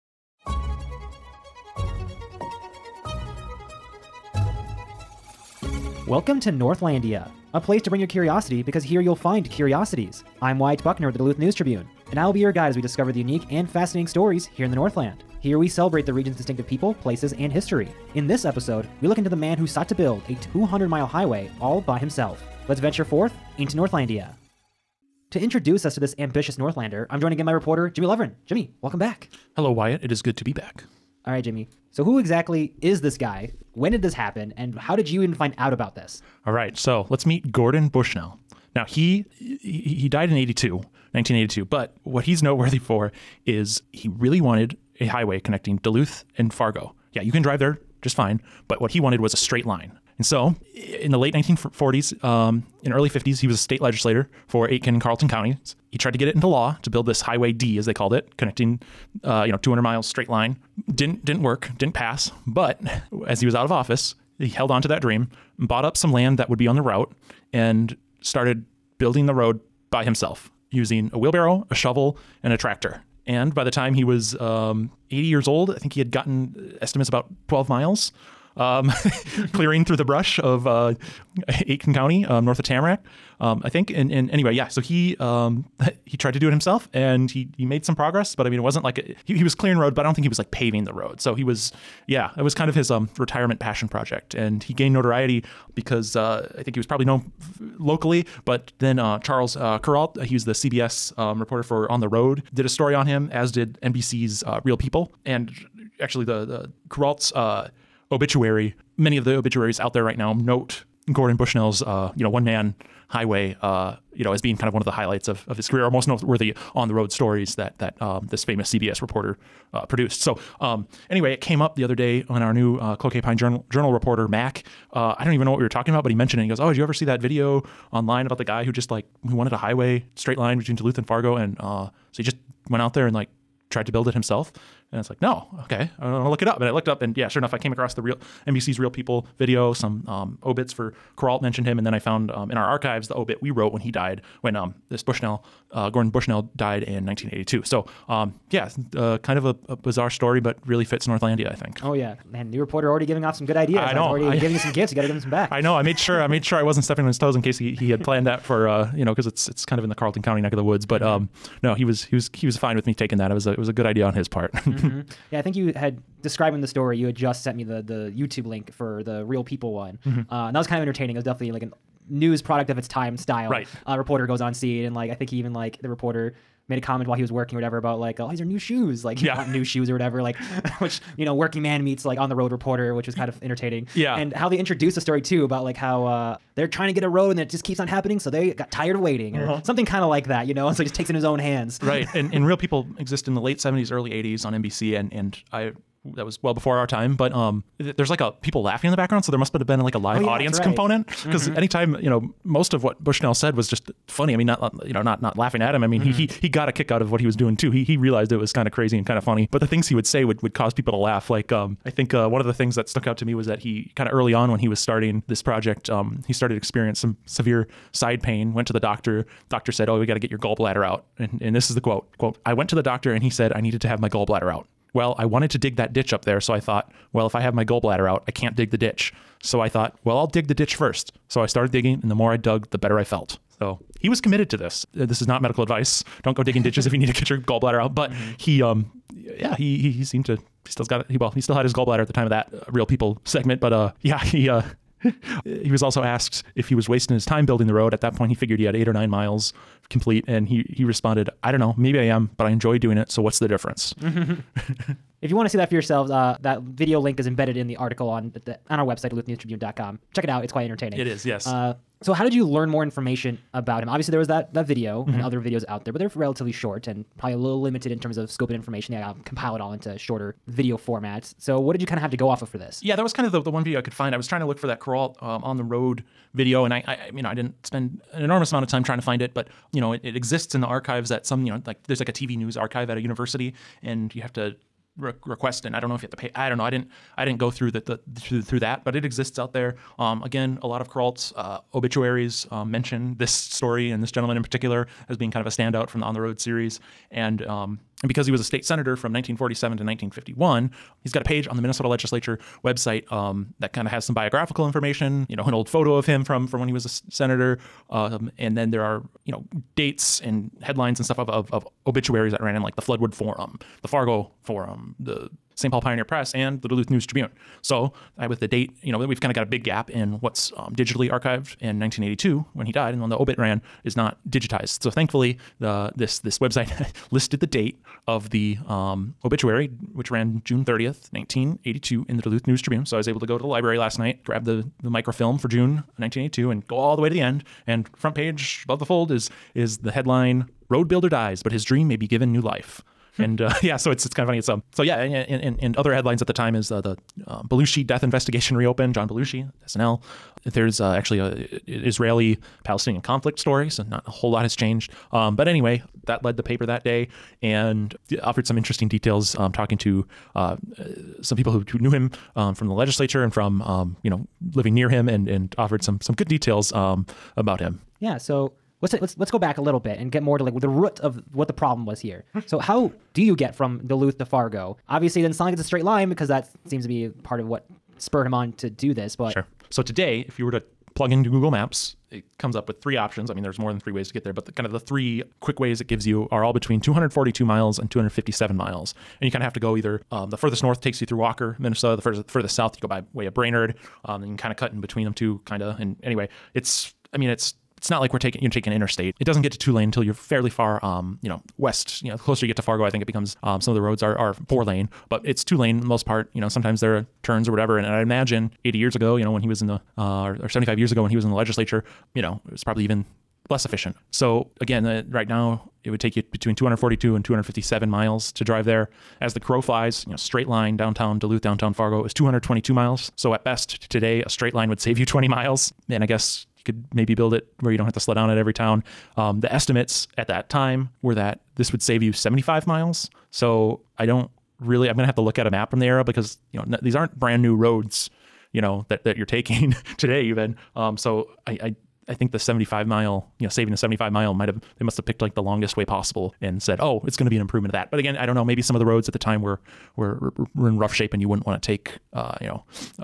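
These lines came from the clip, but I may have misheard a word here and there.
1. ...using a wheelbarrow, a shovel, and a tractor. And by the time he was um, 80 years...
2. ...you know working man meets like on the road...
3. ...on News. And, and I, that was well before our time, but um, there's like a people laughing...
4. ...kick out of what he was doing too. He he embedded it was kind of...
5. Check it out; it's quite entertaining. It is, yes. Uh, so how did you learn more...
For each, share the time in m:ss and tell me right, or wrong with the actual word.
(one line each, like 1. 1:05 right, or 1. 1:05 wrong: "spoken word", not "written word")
1. 1:10 right
2. 3:01 right
3. 3:14 wrong: "NBC", not "News"
4. 3:26 wrong: "realized", not "embedded"
5. 4:20 right.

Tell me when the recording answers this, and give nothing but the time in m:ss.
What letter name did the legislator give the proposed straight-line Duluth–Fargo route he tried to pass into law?
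0:57.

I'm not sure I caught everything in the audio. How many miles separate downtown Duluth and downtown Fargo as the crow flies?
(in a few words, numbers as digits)
222 miles.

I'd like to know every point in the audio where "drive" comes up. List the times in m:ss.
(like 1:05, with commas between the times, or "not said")
0:47, 6:58.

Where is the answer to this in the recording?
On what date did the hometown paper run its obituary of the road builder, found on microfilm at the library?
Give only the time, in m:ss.
5:30.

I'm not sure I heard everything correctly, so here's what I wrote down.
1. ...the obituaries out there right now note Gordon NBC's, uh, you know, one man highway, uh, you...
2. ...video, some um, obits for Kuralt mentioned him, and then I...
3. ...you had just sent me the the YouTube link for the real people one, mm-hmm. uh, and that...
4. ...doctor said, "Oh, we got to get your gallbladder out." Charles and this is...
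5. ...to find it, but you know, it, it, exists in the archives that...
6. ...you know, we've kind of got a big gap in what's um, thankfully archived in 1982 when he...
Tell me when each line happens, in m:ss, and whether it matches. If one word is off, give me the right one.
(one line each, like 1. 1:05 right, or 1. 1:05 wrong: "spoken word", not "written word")
1. 1:49 wrong: "Bushnell", not "NBC"
2. 2:19 right
3. 2:46 right
4. 3:39 wrong: "And", not "Charles"
5. 4:38 right
6. 5:18 wrong: "digitally", not "thankfully".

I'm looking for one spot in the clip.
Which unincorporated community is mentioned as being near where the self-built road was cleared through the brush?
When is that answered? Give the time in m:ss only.
1:22.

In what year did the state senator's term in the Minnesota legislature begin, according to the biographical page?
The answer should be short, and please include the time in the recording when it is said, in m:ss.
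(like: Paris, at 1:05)
1947, at 4:59.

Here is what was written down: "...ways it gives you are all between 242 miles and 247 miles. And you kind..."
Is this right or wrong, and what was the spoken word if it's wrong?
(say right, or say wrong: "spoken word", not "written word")
wrong: "257", not "247".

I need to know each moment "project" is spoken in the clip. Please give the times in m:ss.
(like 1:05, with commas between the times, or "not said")
1:33, 3:35.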